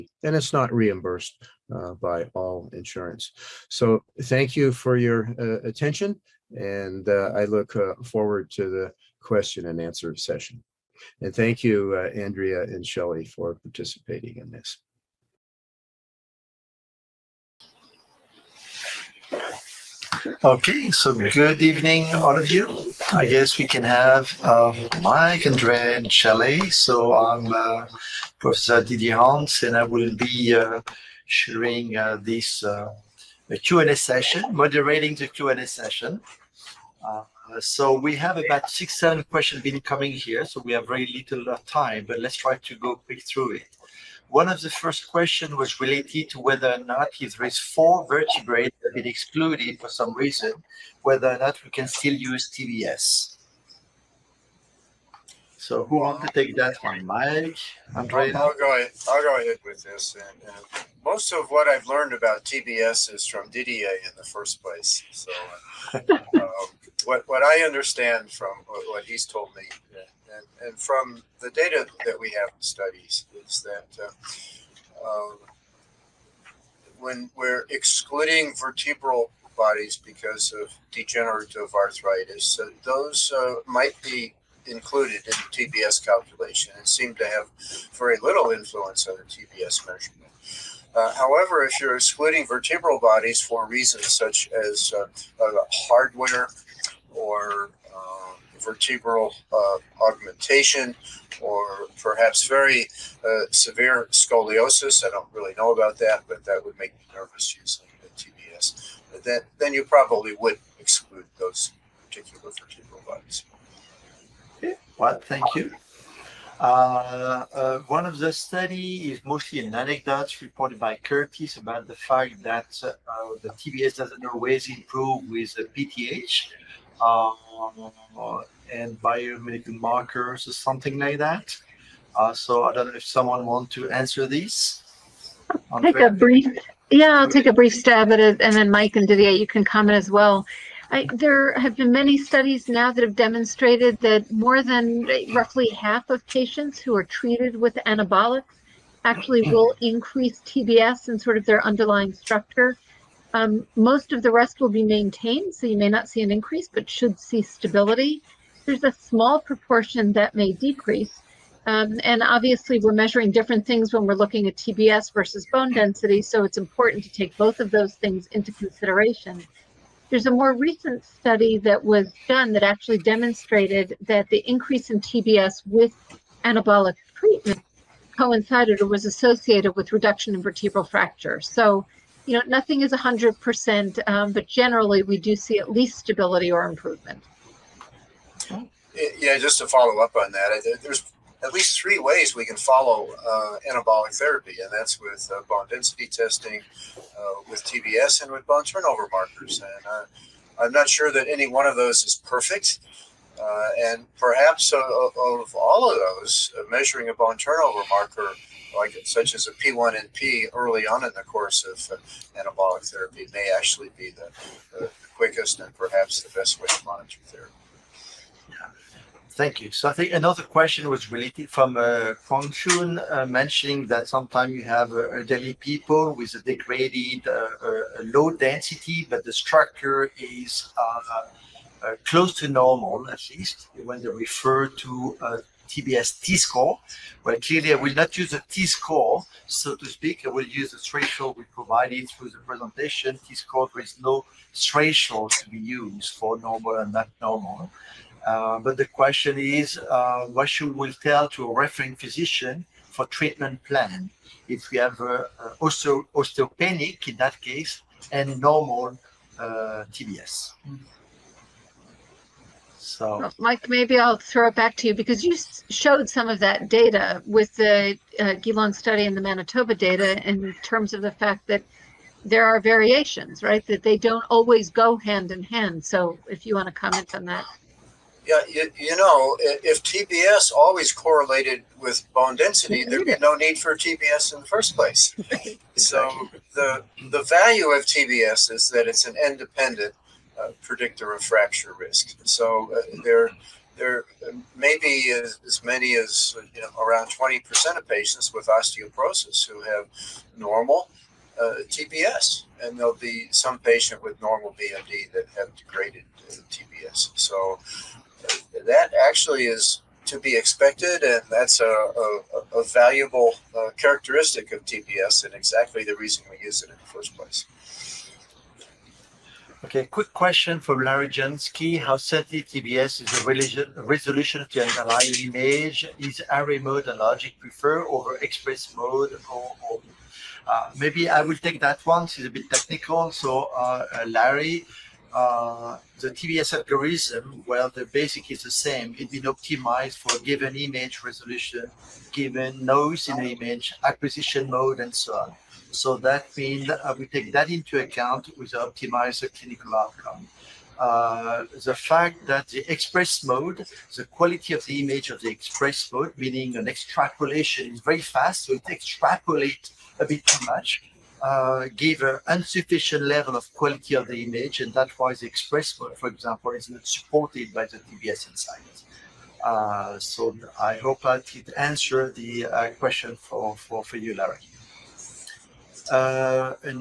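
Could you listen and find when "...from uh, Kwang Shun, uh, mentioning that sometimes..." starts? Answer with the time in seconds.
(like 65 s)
221 s.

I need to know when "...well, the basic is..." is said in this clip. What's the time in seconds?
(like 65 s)
337 s.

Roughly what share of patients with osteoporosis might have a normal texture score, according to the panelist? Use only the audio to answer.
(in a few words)
20%.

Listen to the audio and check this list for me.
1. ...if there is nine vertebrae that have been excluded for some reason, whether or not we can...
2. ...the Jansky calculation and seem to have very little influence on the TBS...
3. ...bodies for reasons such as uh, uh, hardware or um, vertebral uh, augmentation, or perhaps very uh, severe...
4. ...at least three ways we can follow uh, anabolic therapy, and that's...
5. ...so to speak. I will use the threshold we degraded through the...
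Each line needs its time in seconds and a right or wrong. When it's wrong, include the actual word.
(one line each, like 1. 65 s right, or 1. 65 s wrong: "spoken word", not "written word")
1. 47 s wrong: "four", not "nine"
2. 85 s wrong: "TBS", not "Jansky"
3. 92 s right
4. 191 s right
5. 239 s wrong: "provided", not "degraded".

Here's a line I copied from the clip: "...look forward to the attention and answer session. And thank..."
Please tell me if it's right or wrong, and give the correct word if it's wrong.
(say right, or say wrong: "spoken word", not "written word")
wrong: "question", not "attention".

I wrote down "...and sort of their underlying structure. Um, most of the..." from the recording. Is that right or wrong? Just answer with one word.
right.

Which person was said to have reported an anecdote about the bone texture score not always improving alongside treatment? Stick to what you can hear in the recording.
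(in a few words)
Curtis.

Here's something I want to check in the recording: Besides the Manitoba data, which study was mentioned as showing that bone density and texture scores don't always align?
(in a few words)
Geelong study.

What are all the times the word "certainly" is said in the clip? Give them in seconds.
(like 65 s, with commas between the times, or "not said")
321 s.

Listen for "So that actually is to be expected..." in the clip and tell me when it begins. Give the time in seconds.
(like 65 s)
307 s.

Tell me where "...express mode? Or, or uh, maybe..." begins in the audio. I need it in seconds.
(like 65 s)
328 s.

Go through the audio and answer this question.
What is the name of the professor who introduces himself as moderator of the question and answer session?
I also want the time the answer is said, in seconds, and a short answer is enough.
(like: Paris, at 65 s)
Didier Hans, at 28 s.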